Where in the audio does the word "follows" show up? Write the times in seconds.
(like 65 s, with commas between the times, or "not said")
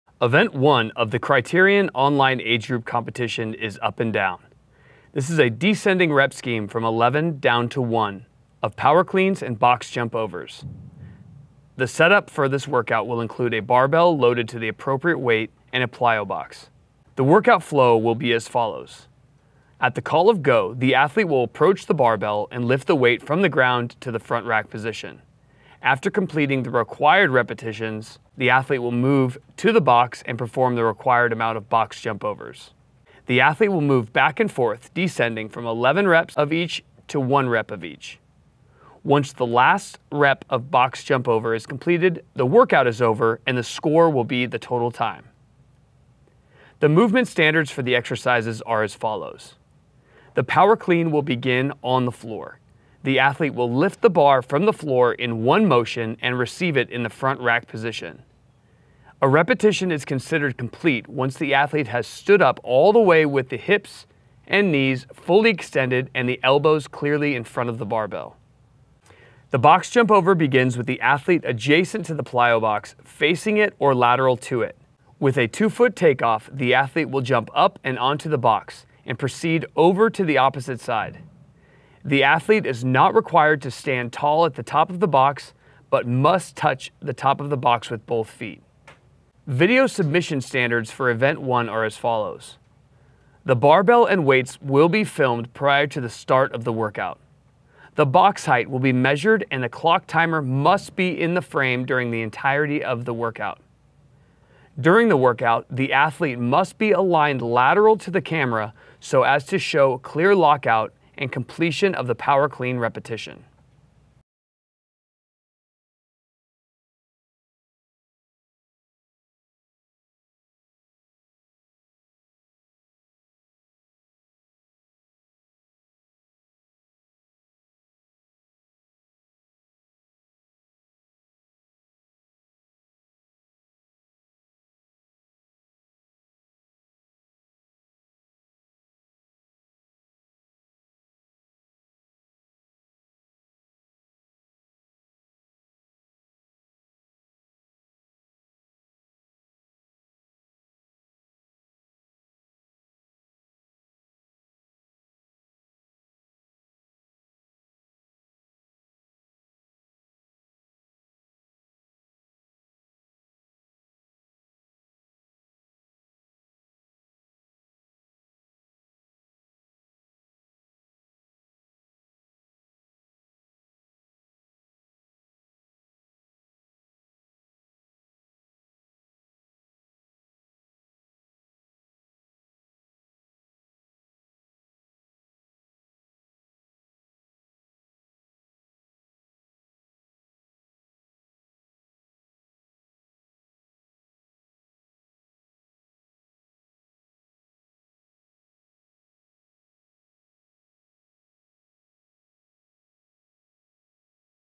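18 s, 48 s, 91 s.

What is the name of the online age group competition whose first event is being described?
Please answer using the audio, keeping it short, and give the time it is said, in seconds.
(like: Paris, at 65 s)
Kriterion, at 1 s.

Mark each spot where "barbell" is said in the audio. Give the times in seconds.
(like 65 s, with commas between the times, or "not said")
13 s, 21 s, 67 s, 93 s.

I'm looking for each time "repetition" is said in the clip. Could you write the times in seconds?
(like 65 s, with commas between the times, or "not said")
27 s, 59 s, 112 s.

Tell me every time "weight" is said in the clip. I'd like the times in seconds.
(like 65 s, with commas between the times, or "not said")
15 s, 22 s, 94 s.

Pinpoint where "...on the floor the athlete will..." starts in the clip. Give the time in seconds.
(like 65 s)
51 s.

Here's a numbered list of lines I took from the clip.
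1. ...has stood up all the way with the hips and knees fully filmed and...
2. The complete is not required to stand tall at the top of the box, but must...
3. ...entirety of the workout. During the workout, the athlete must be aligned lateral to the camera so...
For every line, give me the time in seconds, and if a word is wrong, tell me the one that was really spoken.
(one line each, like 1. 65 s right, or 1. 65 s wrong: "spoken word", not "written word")
1. 61 s wrong: "extended", not "filmed"
2. 82 s wrong: "athlete", not "complete"
3. 102 s right.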